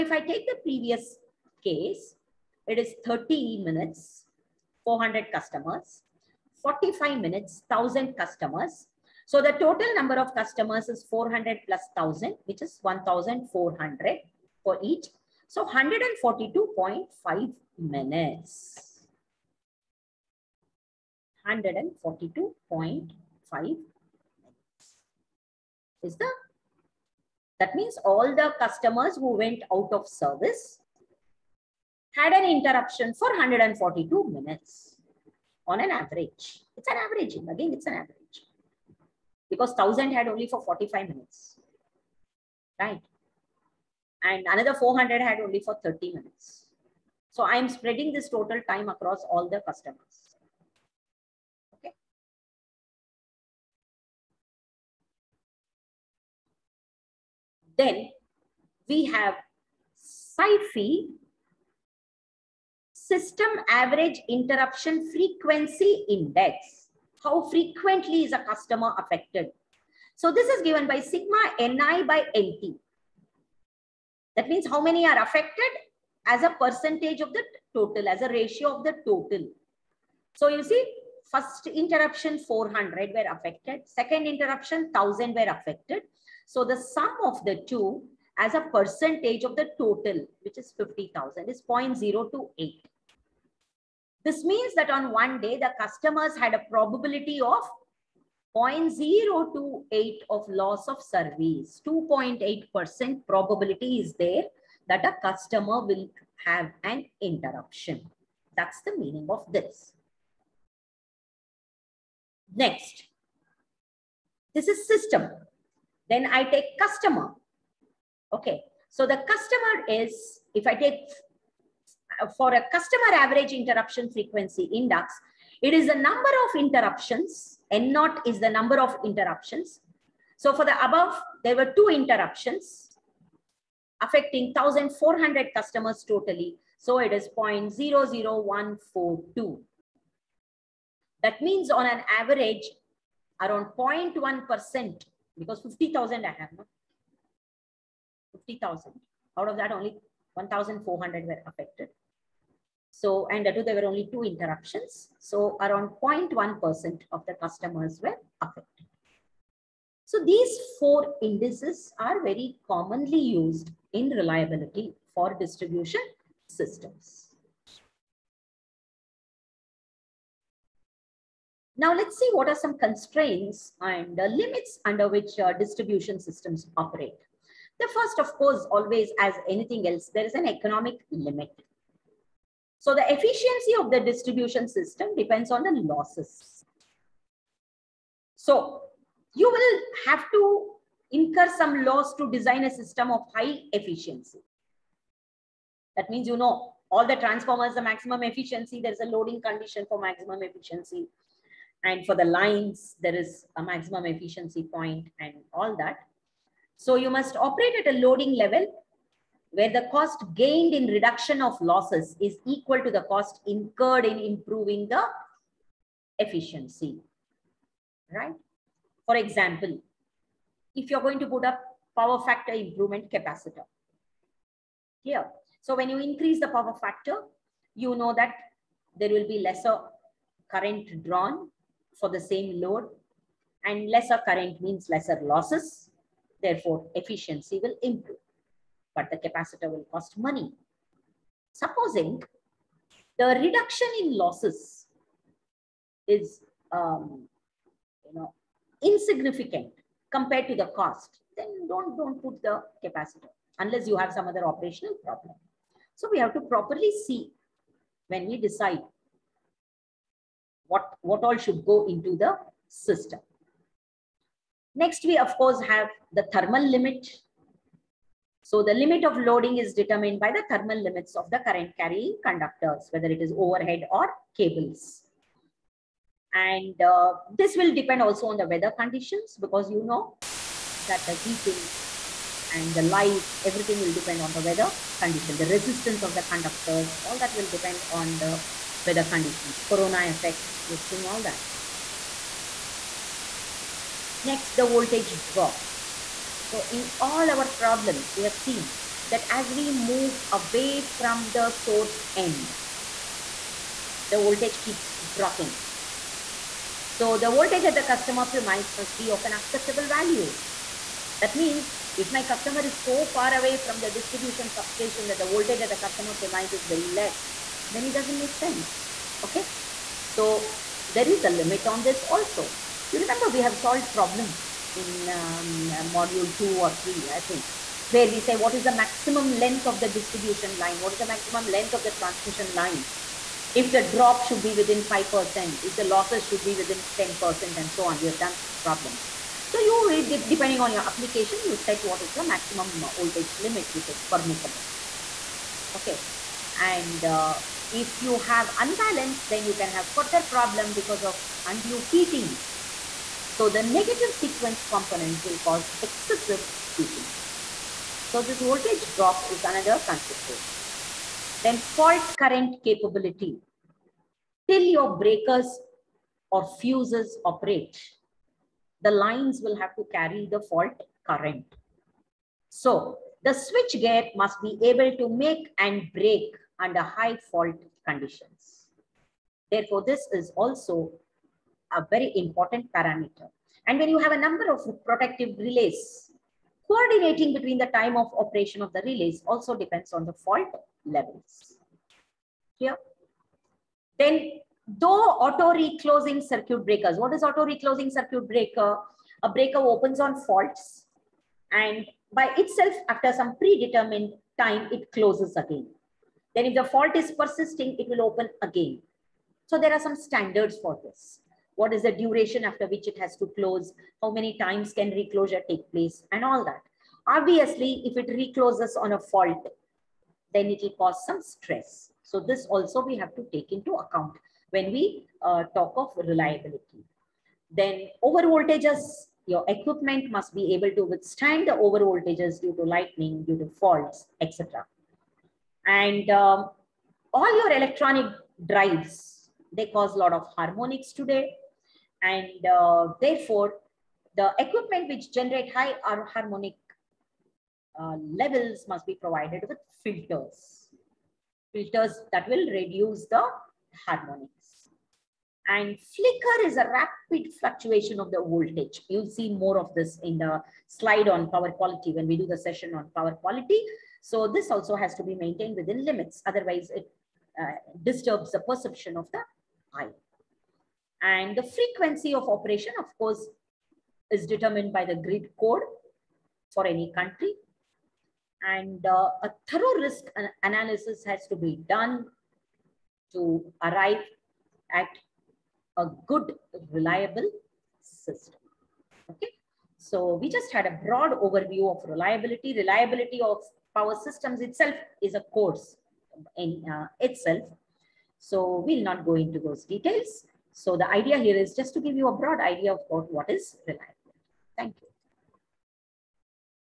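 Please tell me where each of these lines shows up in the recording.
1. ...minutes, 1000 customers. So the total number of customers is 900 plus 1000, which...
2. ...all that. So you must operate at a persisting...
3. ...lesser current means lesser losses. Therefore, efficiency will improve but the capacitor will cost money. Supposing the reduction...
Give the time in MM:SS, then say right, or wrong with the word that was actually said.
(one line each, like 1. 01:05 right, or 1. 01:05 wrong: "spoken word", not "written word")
1. 00:07 wrong: "400", not "900"
2. 03:25 wrong: "loading", not "persisting"
3. 03:53 right.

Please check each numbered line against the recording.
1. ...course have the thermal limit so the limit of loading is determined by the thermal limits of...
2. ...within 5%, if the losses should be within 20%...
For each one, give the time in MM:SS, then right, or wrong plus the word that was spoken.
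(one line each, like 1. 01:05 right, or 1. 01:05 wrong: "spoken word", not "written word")
1. 04:25 right
2. 05:34 wrong: "10", not "20".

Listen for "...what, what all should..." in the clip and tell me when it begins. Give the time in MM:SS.
04:20.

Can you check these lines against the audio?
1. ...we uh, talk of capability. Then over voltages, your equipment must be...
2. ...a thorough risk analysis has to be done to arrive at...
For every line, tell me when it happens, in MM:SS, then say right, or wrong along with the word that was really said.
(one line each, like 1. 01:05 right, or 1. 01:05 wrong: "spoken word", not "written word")
1. 07:04 wrong: "reliability", not "capability"
2. 07:59 right.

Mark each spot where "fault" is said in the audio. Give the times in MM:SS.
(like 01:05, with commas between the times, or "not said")
06:01, 06:10, 06:17, 06:30, 06:40, 06:46, 06:58, 07:13.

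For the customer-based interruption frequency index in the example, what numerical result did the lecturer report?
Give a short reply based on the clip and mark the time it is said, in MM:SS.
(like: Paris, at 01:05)
0.00142, at 02:17.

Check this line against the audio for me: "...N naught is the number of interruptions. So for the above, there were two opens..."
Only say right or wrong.
wrong.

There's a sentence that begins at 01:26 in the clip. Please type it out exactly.
So the sum of the two as a percentage of the total, which is 50,000, is 0.028.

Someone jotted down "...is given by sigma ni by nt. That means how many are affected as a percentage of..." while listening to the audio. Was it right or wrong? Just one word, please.
right.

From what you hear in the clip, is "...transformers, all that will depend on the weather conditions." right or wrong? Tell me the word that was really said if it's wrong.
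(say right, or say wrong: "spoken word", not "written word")
wrong: "conductors", not "transformers".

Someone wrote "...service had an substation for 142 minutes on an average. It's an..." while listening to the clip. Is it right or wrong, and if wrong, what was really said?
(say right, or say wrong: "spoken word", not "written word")
wrong: "interruption", not "substation".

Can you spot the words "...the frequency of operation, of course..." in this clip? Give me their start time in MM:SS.
07:51.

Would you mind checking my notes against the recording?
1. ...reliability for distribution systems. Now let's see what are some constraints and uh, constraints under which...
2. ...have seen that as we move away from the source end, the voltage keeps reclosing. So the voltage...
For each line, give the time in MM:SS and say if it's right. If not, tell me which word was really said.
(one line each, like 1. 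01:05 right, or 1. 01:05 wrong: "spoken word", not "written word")
1. 02:44 wrong: "limits", not "constraints"
2. 04:58 wrong: "dropping", not "reclosing".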